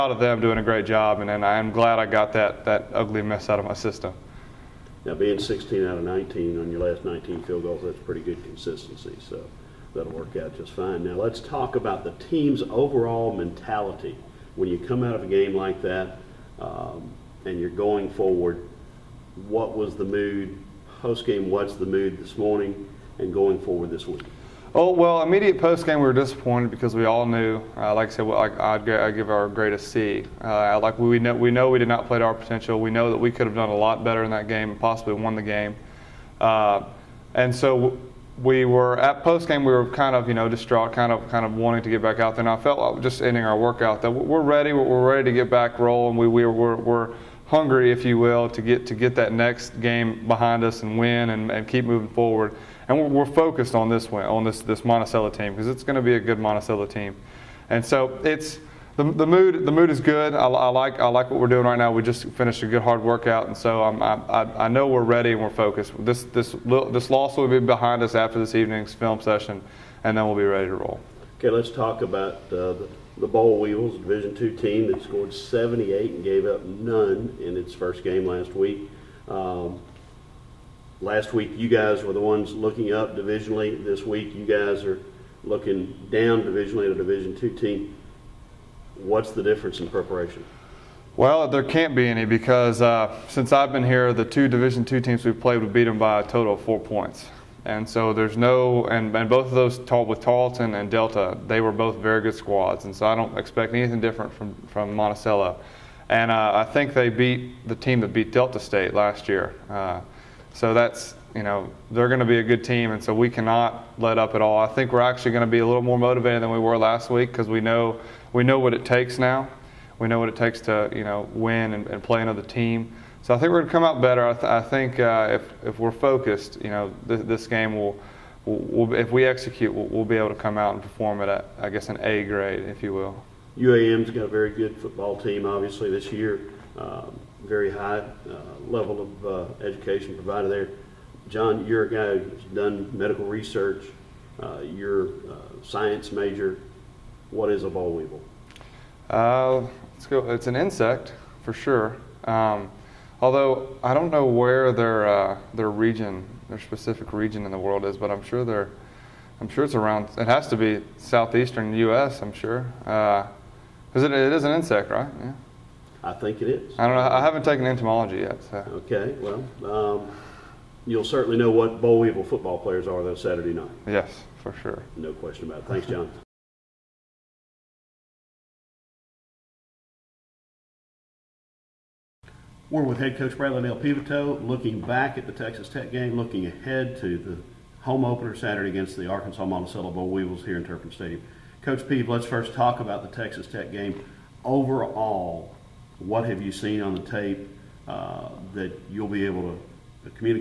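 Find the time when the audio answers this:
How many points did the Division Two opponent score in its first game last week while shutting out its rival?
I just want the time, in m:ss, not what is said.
1:15.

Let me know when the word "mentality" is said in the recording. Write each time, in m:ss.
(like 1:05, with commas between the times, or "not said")
0:13.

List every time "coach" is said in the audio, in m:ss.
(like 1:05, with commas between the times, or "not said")
3:03, 3:11.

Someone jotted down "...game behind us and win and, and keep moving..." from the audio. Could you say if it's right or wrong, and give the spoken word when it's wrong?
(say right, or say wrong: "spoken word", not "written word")
right.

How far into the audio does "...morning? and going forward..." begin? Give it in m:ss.
0:22.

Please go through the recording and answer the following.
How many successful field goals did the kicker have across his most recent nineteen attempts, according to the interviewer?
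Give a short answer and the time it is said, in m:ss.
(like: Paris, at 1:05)
16, at 0:05.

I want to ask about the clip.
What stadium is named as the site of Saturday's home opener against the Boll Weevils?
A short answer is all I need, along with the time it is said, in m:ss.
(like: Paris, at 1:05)
Turpin Stadium, at 3:10.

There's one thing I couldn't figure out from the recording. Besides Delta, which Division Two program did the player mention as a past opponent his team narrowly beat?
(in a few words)
Tarleton.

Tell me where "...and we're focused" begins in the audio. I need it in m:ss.
1:05.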